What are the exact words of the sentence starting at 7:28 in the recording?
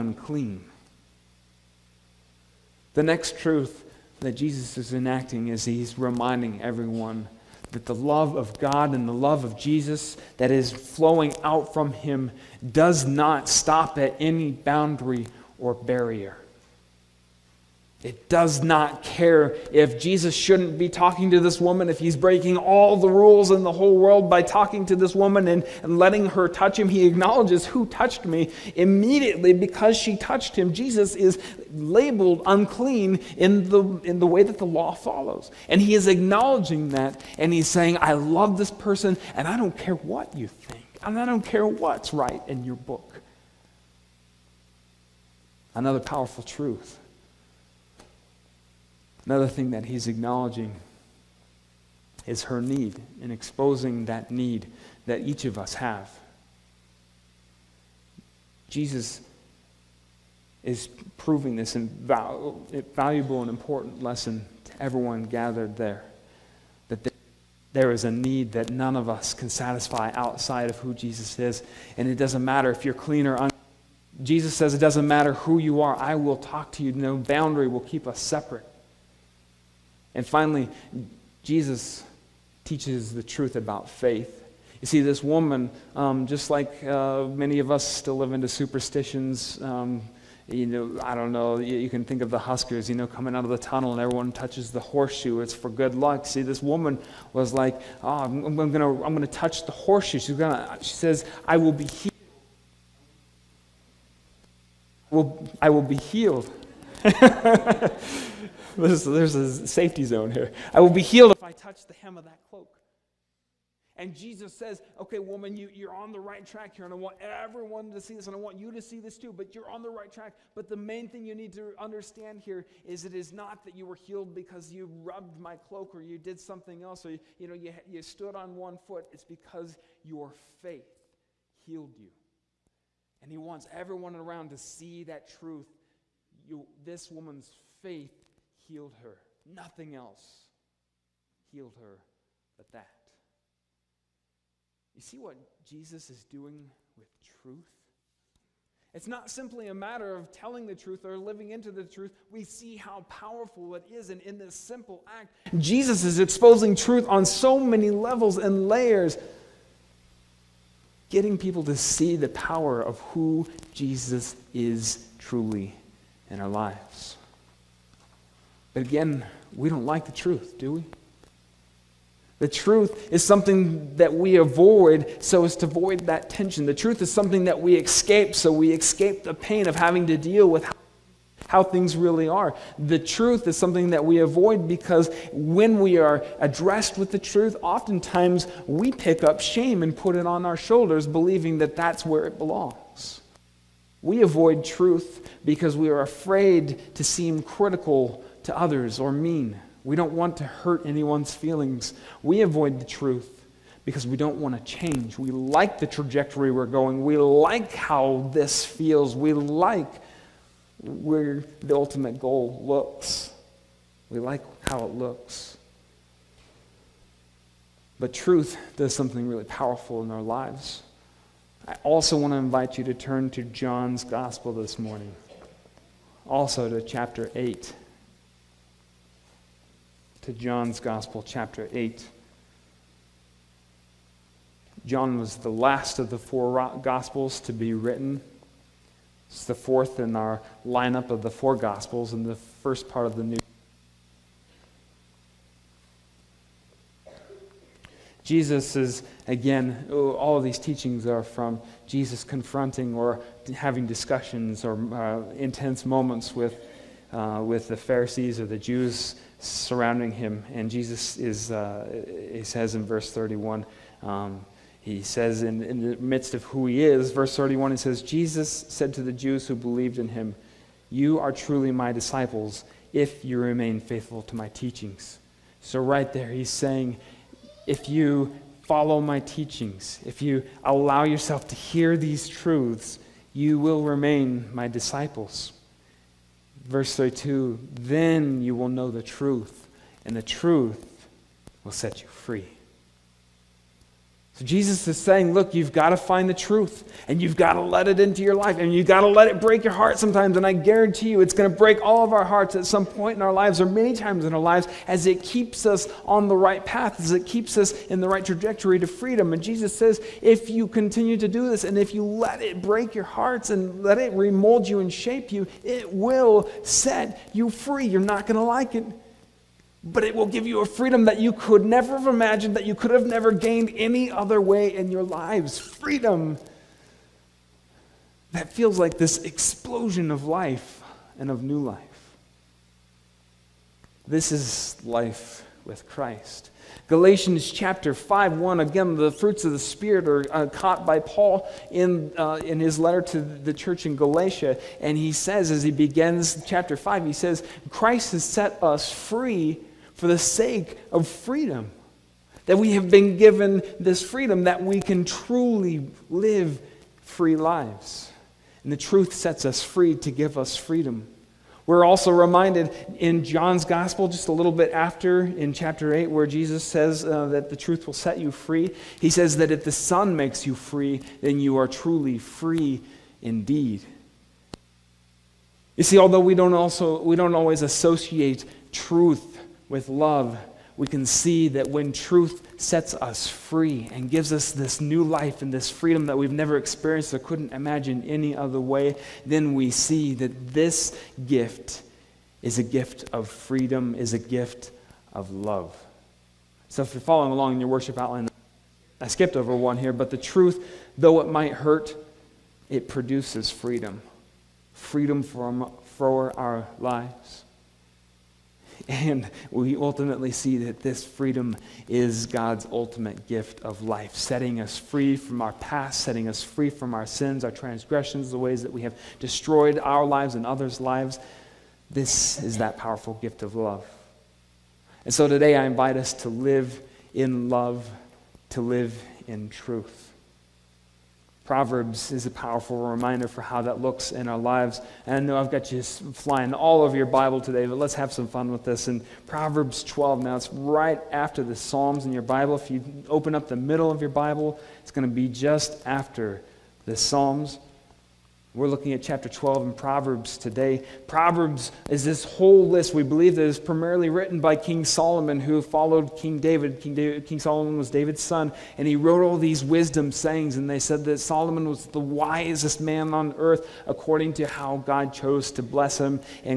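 We're looking at chapter 12 in Proverbs today.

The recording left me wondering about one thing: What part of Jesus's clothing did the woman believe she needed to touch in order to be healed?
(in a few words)
hem of that cloak.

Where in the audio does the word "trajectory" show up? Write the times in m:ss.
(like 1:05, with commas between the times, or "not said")
3:25, 5:08.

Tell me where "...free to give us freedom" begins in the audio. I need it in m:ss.
5:59.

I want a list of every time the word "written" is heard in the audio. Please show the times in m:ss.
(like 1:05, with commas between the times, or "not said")
3:57, 7:34.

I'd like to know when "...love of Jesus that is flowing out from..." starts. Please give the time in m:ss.
0:09.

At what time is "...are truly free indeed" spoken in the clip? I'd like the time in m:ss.
6:11.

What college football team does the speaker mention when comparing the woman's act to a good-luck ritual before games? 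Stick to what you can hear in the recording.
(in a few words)
Huskers.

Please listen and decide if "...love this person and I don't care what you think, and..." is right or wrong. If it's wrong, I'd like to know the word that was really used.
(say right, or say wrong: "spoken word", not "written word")
right.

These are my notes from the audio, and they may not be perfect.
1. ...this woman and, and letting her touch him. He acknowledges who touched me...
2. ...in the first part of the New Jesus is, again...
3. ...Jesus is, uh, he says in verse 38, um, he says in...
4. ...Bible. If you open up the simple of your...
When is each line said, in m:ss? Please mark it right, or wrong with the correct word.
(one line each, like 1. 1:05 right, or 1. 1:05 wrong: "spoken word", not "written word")
1. 0:24 right
2. 4:02 right
3. 4:20 wrong: "31", not "38"
4. 7:22 wrong: "middle", not "simple".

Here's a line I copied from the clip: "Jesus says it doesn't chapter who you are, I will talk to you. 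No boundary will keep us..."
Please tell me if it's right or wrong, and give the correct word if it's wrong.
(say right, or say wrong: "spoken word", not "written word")
wrong: "matter", not "chapter".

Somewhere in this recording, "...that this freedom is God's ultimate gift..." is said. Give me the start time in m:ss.
6:50.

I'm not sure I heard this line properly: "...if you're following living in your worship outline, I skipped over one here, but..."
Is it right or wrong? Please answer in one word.
wrong.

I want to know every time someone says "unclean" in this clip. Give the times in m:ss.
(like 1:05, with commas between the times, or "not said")
0:32, 1:13.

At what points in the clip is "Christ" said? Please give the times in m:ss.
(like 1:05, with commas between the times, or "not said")
5:35, 5:47.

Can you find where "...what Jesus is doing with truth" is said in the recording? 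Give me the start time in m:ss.
2:25.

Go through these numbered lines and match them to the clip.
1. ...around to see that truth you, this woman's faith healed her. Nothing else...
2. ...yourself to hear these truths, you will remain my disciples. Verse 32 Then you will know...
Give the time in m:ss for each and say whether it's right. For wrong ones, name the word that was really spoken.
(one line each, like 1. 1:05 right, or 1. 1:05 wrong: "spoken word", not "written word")
1. 2:14 right
2. 4:41 right.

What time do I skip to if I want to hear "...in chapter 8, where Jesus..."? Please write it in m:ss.
6:05.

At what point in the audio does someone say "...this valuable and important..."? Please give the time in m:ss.
1:01.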